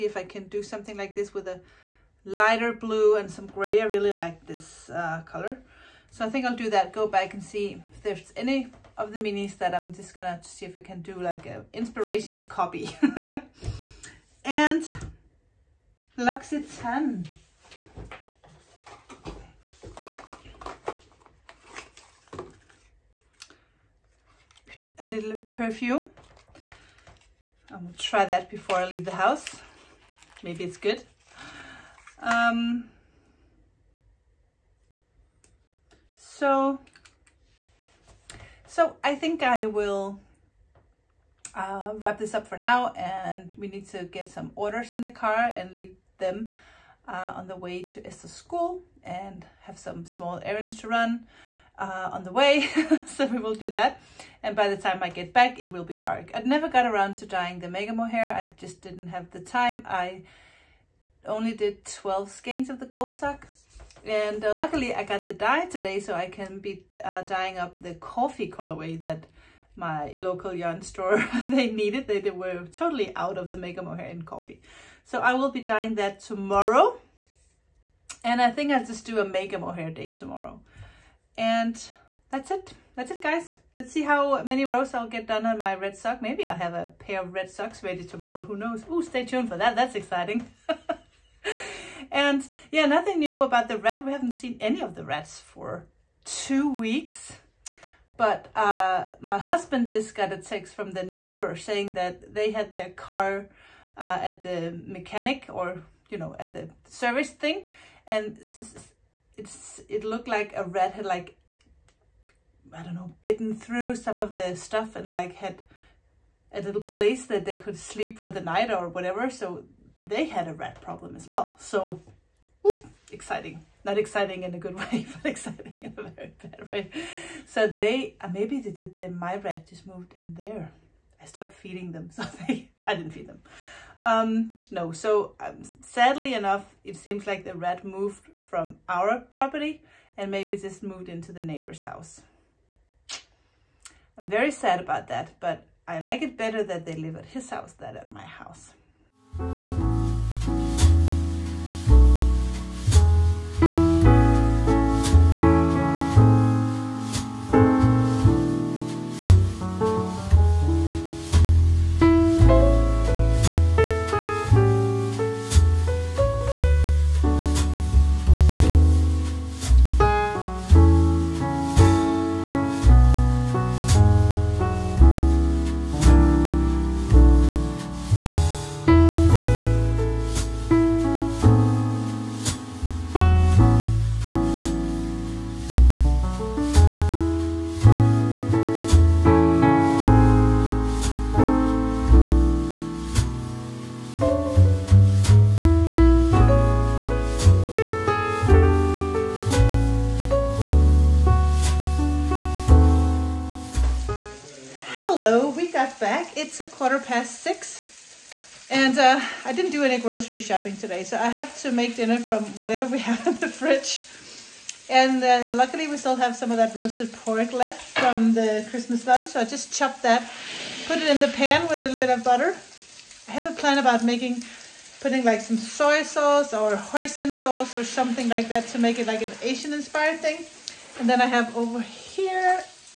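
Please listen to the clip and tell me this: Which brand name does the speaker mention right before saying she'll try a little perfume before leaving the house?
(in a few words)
L'Occitane.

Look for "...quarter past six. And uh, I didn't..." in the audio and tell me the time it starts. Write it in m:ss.
3:26.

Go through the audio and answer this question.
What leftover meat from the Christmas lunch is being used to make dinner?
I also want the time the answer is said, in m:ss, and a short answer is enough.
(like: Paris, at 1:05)
roasted pork, at 3:36.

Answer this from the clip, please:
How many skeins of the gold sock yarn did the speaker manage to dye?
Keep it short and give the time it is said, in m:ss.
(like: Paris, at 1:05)
12, at 1:01.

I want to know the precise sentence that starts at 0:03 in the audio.
I really like this uh, color.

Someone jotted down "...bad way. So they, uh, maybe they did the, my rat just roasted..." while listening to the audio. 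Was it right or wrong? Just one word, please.
wrong.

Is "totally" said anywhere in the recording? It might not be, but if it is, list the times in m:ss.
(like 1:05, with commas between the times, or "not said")
1:12.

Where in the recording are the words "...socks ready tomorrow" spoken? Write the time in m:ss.
1:27.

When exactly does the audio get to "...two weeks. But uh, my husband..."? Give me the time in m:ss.
1:36.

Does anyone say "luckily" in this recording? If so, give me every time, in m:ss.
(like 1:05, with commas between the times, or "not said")
1:04, 3:35.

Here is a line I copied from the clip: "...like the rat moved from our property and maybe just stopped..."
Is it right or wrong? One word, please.
wrong.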